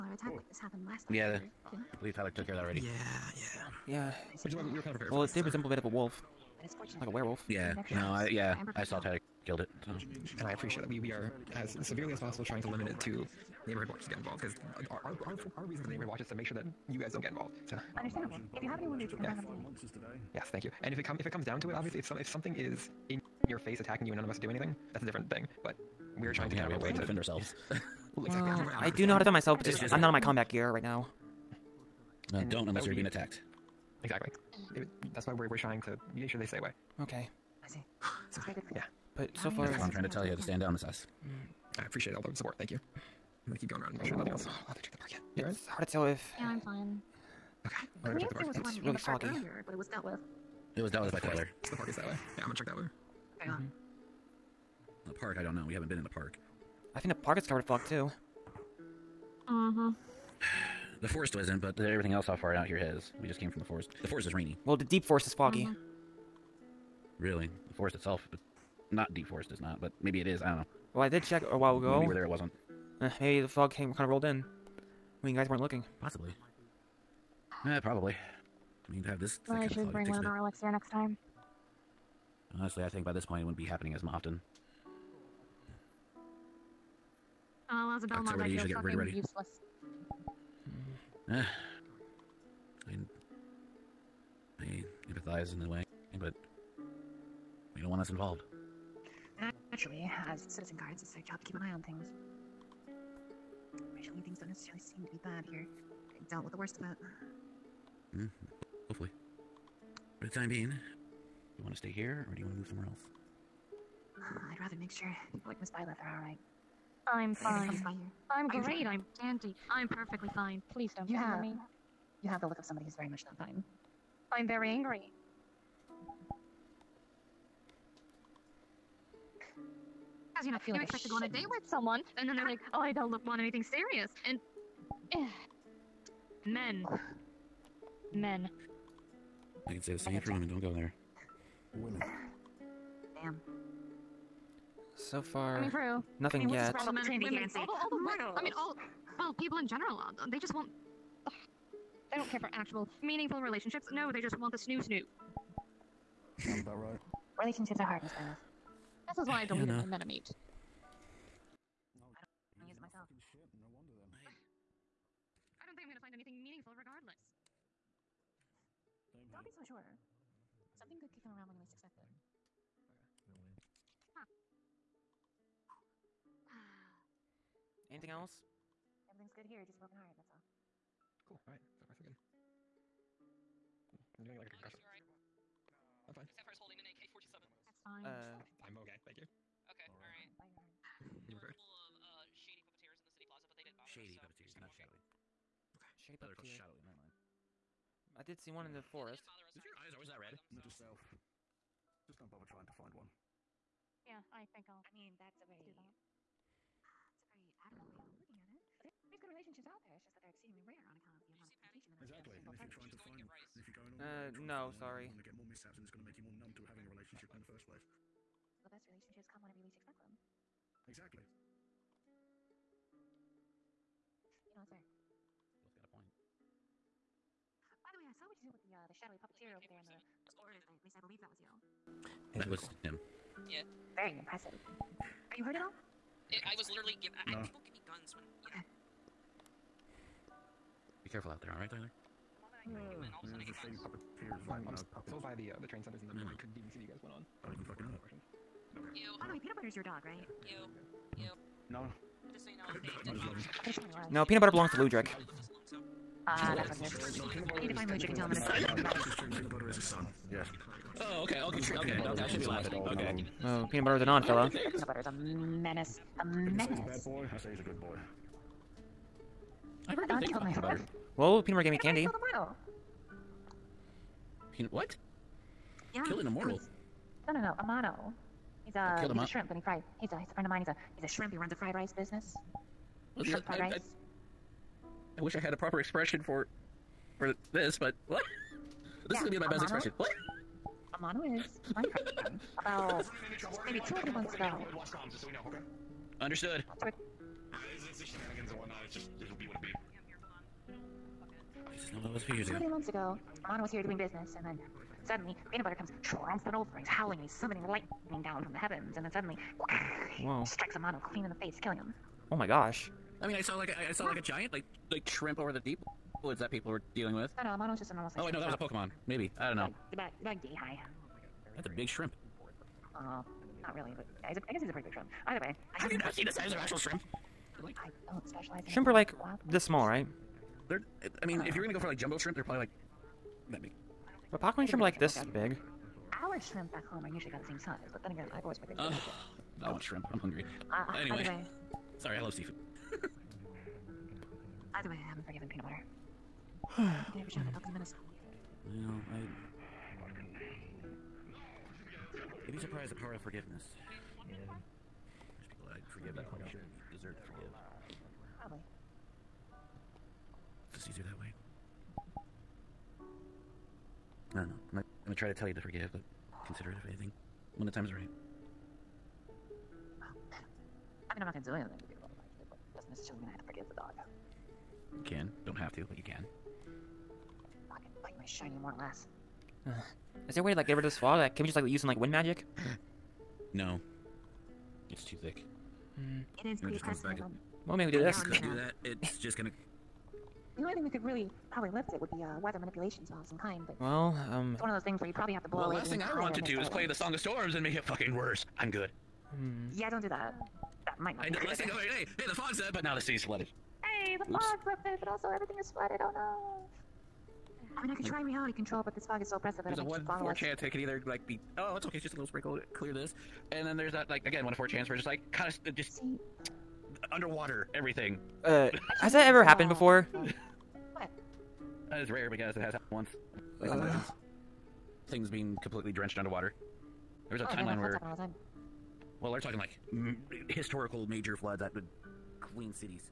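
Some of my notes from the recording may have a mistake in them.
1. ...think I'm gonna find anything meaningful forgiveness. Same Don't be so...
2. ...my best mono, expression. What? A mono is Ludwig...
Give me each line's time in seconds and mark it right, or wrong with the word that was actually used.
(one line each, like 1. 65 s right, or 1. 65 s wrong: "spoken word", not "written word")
1. 165 s wrong: "regardless", not "forgiveness"
2. 289 s wrong: "Minecraft", not "Ludwig".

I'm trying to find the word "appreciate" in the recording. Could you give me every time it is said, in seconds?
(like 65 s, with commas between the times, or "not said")
10 s, 41 s.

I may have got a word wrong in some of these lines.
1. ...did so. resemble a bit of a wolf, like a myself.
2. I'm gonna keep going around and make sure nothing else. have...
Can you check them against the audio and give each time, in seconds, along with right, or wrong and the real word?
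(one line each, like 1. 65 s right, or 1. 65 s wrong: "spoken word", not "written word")
1. 5 s wrong: "werewolf", not "myself"
2. 42 s right.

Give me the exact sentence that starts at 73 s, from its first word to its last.
Uh, maybe the fog came kind of rolled in when you guys weren't looking.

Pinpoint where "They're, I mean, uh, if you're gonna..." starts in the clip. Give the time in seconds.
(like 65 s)
330 s.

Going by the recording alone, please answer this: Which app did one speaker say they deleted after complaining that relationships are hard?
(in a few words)
MetaMate.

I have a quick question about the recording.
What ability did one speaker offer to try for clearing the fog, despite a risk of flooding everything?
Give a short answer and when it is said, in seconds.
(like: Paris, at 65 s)
reality control, at 408 s.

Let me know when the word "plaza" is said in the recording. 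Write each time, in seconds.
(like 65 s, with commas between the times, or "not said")
193 s.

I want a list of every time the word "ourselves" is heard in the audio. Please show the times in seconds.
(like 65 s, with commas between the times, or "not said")
27 s.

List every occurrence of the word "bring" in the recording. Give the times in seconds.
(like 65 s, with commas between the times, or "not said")
19 s, 79 s.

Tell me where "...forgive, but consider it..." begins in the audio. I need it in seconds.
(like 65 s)
365 s.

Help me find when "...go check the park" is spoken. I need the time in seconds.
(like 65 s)
48 s.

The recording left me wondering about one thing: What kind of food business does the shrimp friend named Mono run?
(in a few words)
fried rice.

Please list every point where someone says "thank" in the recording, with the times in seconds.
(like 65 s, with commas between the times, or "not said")
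20 s, 42 s, 189 s.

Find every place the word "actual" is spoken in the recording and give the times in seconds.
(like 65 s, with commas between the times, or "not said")
152 s, 326 s.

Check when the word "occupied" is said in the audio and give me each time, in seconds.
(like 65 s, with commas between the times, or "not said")
not said.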